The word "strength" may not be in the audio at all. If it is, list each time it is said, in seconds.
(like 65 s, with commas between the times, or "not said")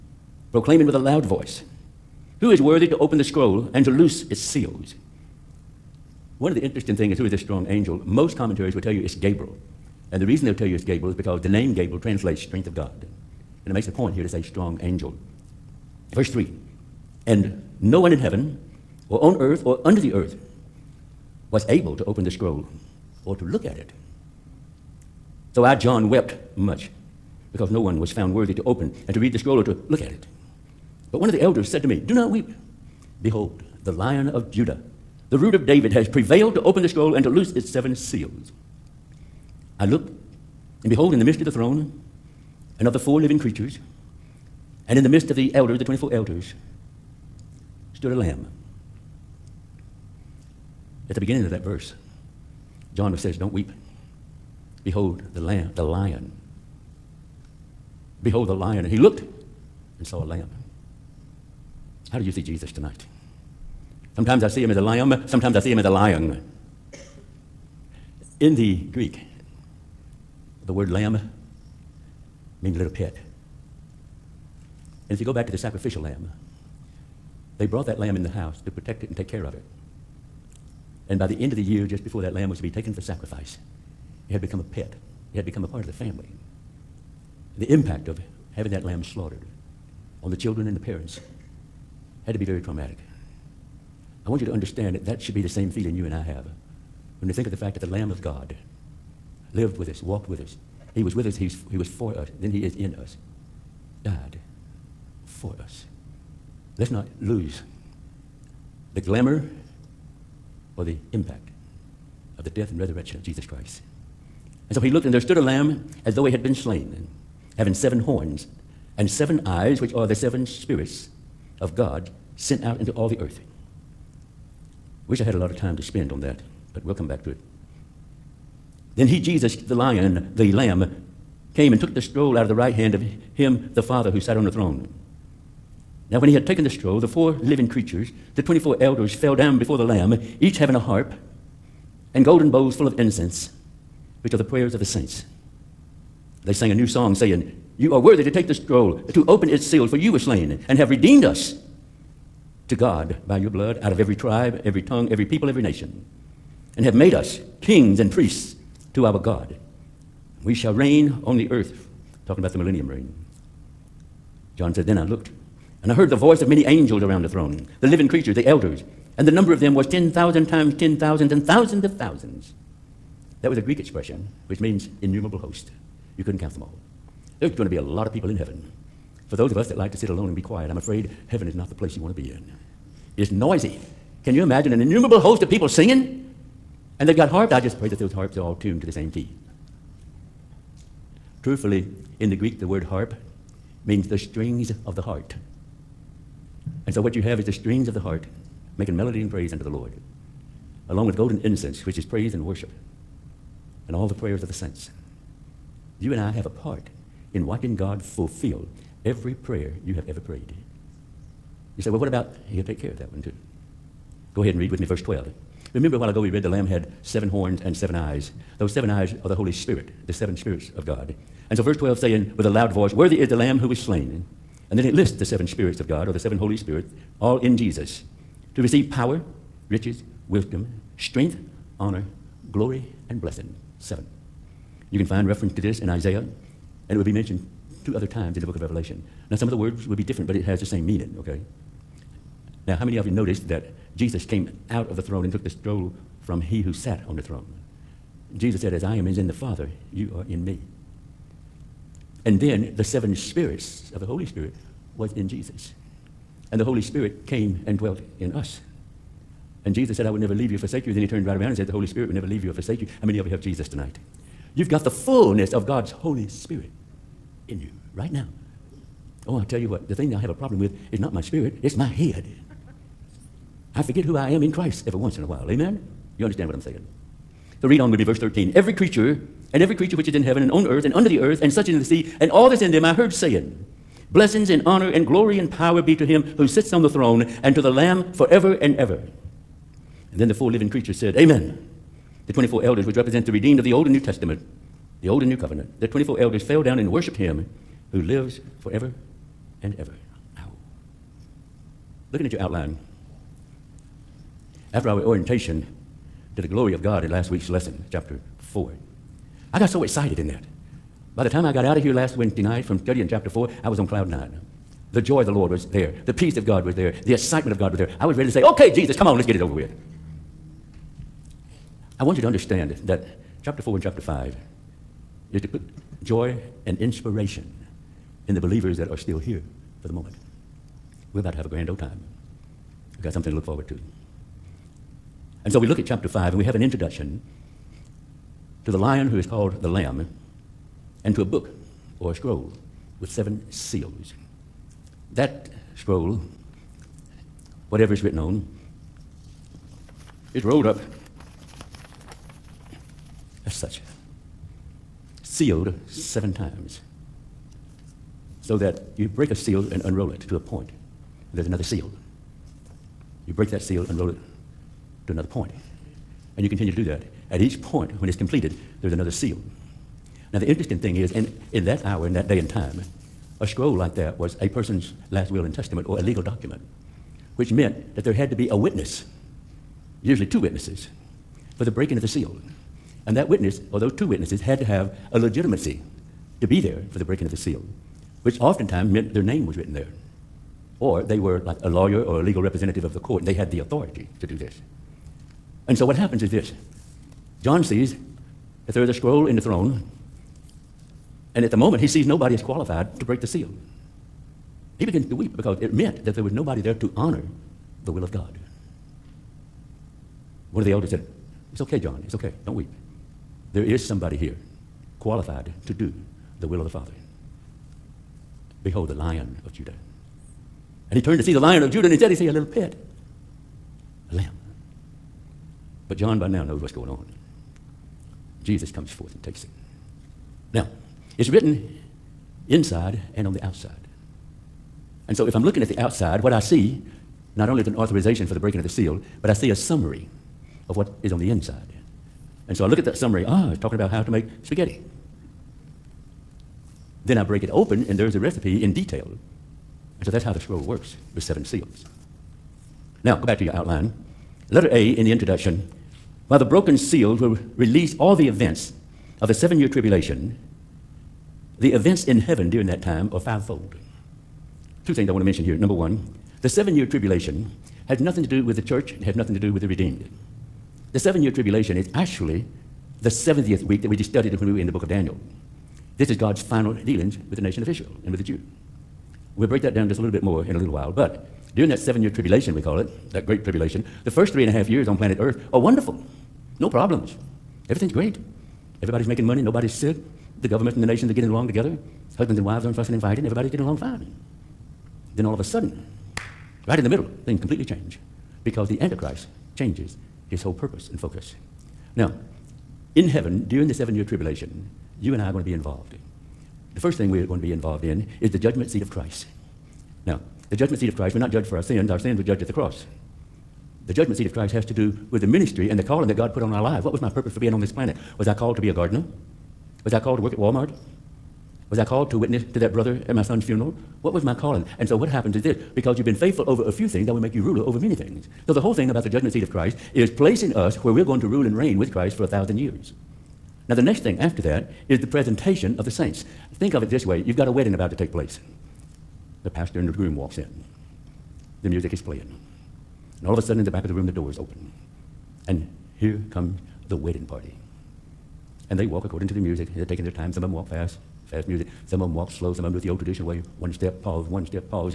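12 s, 230 s.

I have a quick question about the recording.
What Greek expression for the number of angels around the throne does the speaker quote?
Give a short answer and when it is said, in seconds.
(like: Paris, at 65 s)
10,000 times 10,000, at 169 s.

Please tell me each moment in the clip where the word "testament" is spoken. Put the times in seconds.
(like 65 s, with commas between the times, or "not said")
293 s, 375 s.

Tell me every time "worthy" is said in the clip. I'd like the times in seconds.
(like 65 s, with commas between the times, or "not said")
2 s, 28 s, 147 s, 222 s.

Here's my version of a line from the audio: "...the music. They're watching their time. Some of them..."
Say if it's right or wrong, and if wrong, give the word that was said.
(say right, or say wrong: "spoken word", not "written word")
wrong: "taking", not "watching".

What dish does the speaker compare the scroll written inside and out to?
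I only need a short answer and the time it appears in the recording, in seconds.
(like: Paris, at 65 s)
Spaghetti, at 444 s.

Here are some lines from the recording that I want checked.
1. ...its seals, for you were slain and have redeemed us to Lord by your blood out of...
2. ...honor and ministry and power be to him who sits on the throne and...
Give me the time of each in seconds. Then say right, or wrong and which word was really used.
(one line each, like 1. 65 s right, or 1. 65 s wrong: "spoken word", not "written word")
1. 149 s wrong: "God", not "Lord"
2. 284 s wrong: "glory", not "ministry".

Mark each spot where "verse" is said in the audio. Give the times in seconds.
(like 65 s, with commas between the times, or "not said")
16 s, 51 s, 214 s, 221 s, 278 s.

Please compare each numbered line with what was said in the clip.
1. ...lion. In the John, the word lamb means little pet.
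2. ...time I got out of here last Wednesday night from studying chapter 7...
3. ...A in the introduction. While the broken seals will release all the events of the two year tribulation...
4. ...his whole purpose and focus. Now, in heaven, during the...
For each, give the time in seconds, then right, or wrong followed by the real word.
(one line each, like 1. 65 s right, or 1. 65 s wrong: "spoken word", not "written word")
1. 65 s wrong: "Greek", not "John"
2. 311 s wrong: "4", not "7"
3. 454 s wrong: "seven", not "two"
4. 500 s right.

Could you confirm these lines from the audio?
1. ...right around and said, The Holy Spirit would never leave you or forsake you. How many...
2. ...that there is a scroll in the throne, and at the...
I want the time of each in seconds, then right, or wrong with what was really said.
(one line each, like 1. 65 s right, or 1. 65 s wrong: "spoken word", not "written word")
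1. 261 s right
2. 398 s right.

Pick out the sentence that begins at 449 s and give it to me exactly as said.
And so that's how the scroll works with seven seals.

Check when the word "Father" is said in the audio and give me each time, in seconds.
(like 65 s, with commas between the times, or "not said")
133 s, 249 s, 416 s.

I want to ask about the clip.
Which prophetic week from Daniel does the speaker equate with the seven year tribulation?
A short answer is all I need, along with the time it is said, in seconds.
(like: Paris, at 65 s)
The 70th week, at 473 s.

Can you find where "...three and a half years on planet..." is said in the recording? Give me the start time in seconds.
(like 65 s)
484 s.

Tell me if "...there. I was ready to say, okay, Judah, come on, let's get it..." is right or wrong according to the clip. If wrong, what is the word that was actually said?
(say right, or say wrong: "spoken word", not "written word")
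wrong: "Jesus", not "Judah".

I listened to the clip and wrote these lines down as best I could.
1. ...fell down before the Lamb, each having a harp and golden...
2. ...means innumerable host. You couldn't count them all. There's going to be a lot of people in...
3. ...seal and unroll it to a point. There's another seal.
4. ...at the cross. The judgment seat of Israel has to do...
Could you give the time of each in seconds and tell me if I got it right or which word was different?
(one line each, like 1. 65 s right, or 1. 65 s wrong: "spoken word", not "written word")
1. 139 s right
2. 174 s right
3. 359 s right
4. 512 s wrong: "Christ", not "Israel".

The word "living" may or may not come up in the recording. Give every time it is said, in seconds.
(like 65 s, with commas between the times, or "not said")
43 s, 137 s, 167 s, 290 s.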